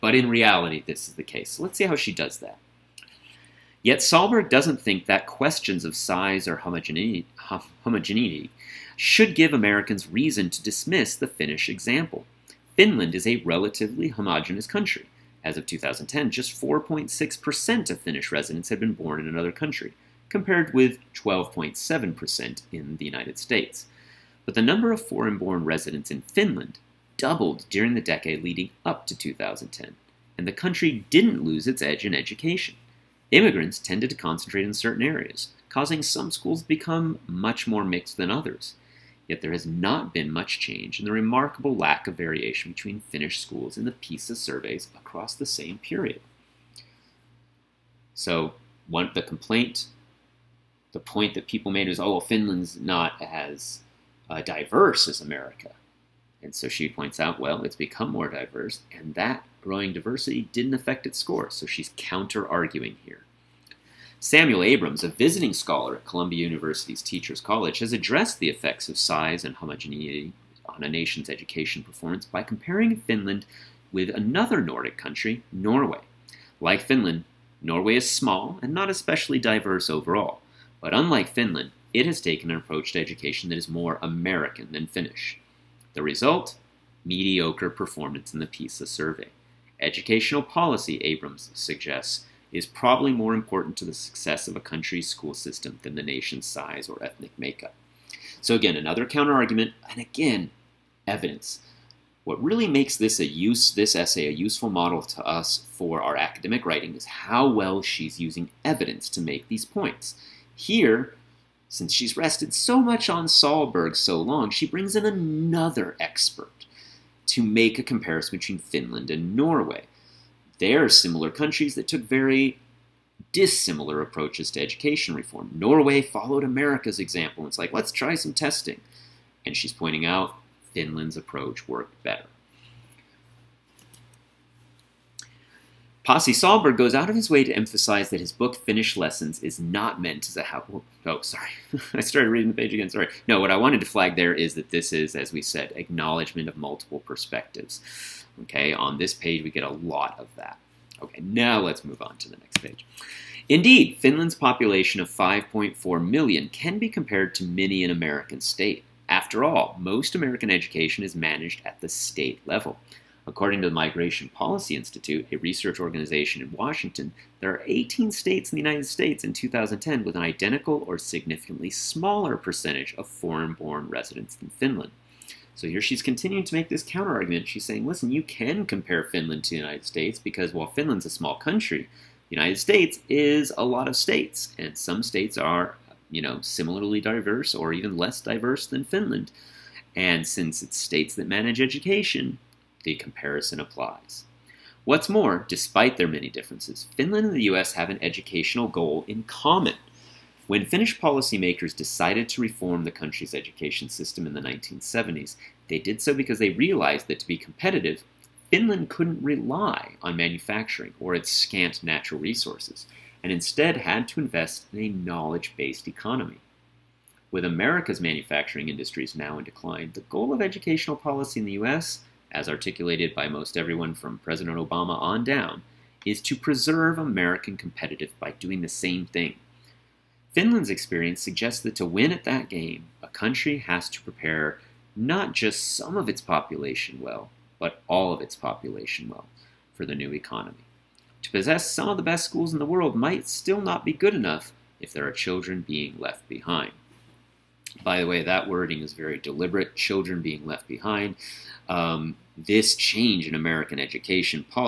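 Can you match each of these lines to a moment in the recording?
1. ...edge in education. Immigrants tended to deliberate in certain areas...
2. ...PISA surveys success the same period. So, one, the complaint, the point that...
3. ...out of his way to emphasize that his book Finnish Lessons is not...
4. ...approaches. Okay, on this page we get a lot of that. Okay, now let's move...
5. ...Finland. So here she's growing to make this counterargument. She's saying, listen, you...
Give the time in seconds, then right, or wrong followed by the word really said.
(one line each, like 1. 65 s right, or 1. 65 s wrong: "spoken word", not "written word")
1. 31 s wrong: "concentrate", not "deliberate"
2. 43 s wrong: "across", not "success"
3. 136 s right
4. 146 s wrong: "perspectives", not "approaches"
5. 174 s wrong: "continuing", not "growing".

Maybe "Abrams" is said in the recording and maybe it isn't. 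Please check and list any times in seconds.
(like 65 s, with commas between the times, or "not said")
64 s, 90 s.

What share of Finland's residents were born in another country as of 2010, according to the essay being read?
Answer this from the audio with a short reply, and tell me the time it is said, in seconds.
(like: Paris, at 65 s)
4.6%, at 16 s.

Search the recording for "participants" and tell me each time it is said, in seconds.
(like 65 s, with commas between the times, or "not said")
not said.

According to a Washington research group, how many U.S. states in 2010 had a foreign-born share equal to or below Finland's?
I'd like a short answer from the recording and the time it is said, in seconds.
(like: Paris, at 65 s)
18, at 167 s.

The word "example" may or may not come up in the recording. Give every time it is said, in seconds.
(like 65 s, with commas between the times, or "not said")
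11 s, 126 s.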